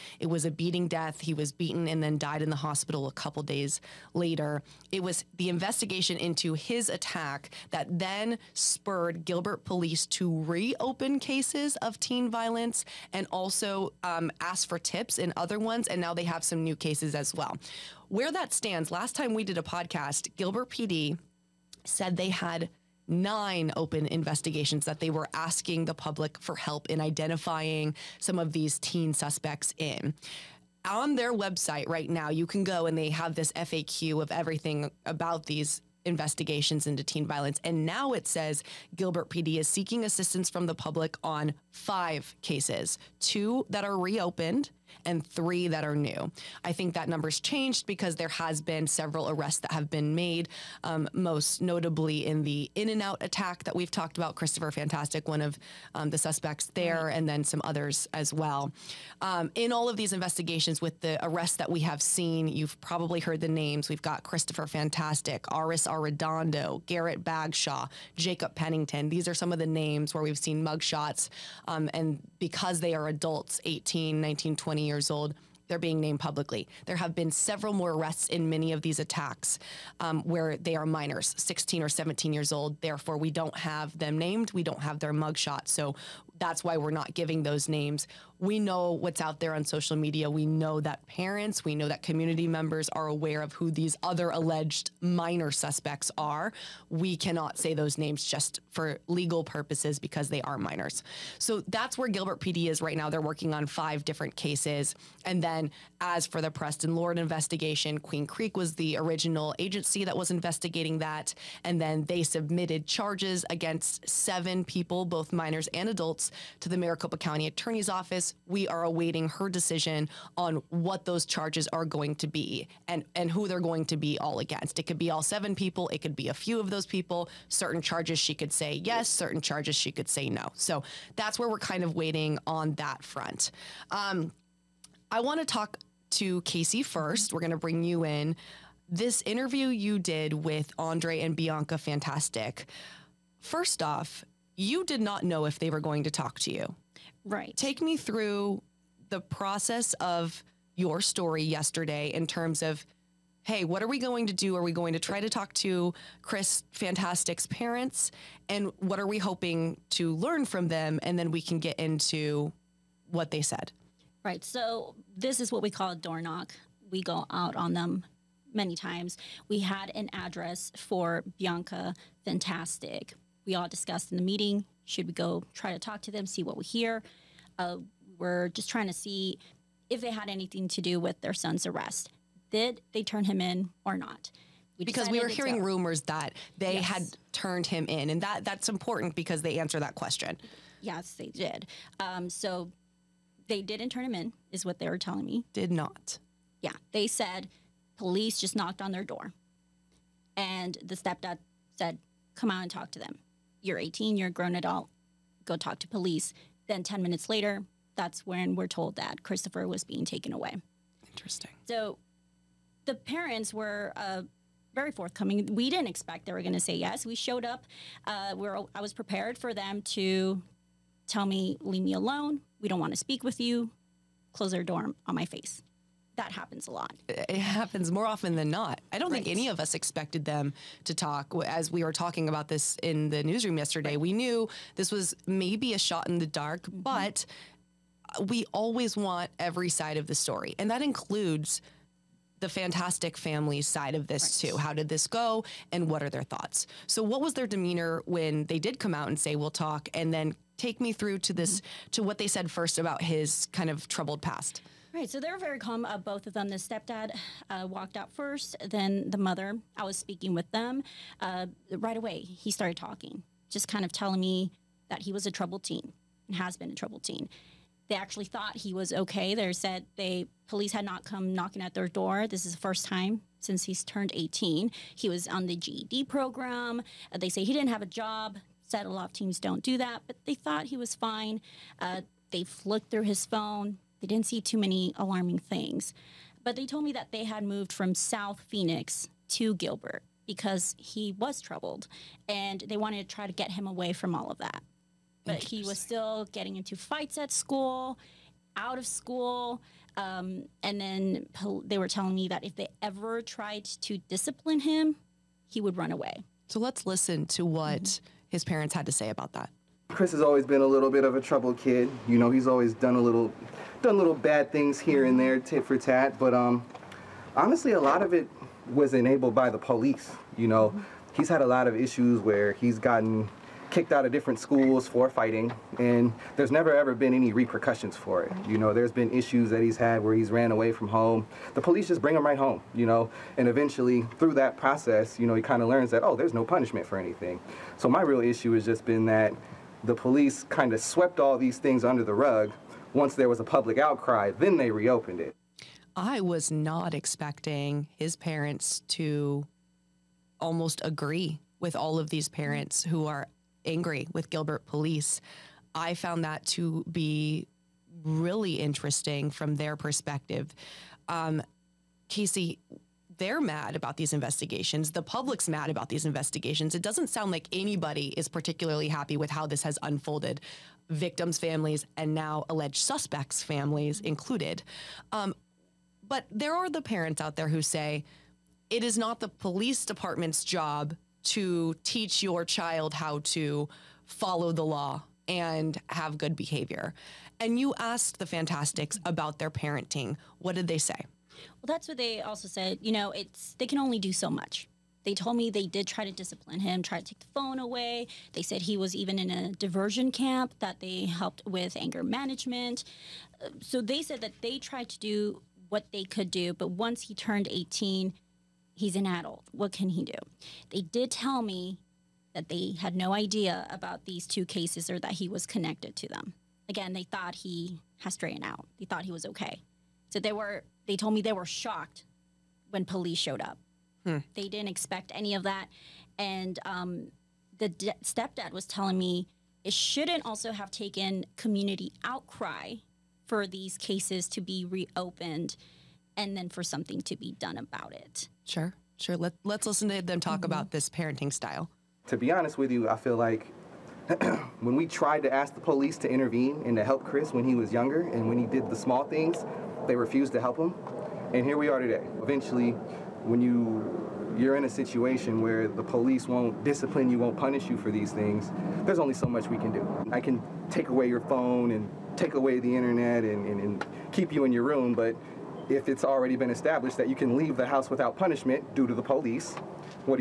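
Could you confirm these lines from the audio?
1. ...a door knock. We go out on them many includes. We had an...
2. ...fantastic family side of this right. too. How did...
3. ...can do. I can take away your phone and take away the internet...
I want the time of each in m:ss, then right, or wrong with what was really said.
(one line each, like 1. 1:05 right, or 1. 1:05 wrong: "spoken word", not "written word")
1. 2:45 wrong: "times", not "includes"
2. 4:02 right
3. 7:39 right.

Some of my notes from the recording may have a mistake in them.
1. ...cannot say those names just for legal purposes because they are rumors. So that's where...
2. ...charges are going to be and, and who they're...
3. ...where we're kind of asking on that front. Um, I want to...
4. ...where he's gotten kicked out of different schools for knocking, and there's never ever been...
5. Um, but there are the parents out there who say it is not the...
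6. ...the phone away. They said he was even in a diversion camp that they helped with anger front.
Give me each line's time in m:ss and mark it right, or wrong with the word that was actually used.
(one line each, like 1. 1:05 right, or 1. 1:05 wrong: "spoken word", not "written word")
1. 1:37 wrong: "minors", not "rumors"
2. 2:01 right
3. 2:11 wrong: "waiting", not "asking"
4. 5:22 wrong: "fighting", not "knocking"
5. 6:15 right
6. 6:37 wrong: "management", not "front".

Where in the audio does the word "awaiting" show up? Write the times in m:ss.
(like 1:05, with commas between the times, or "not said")
1:58.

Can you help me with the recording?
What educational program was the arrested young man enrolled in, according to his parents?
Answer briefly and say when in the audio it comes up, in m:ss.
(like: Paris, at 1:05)
GED program, at 4:35.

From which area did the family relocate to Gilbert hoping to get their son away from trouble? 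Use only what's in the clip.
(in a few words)
South Phoenix.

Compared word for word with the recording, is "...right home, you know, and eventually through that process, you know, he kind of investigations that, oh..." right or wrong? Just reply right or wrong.
wrong.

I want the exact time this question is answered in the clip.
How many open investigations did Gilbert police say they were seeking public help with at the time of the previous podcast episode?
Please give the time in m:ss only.
0:23.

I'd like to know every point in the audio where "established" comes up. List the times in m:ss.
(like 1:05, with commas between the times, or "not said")
7:46.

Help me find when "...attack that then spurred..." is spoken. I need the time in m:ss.
0:06.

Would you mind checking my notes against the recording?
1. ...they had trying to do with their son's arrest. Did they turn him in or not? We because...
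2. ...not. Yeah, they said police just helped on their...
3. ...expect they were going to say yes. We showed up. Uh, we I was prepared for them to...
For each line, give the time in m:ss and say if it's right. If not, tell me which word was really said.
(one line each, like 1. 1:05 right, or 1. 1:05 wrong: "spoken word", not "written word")
1. 3:00 wrong: "anything", not "trying"
2. 3:15 wrong: "knocked", not "helped"
3. 3:35 right.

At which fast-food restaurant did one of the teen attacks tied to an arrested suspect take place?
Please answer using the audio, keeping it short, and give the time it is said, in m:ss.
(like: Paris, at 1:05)
In and Out, at 0:52.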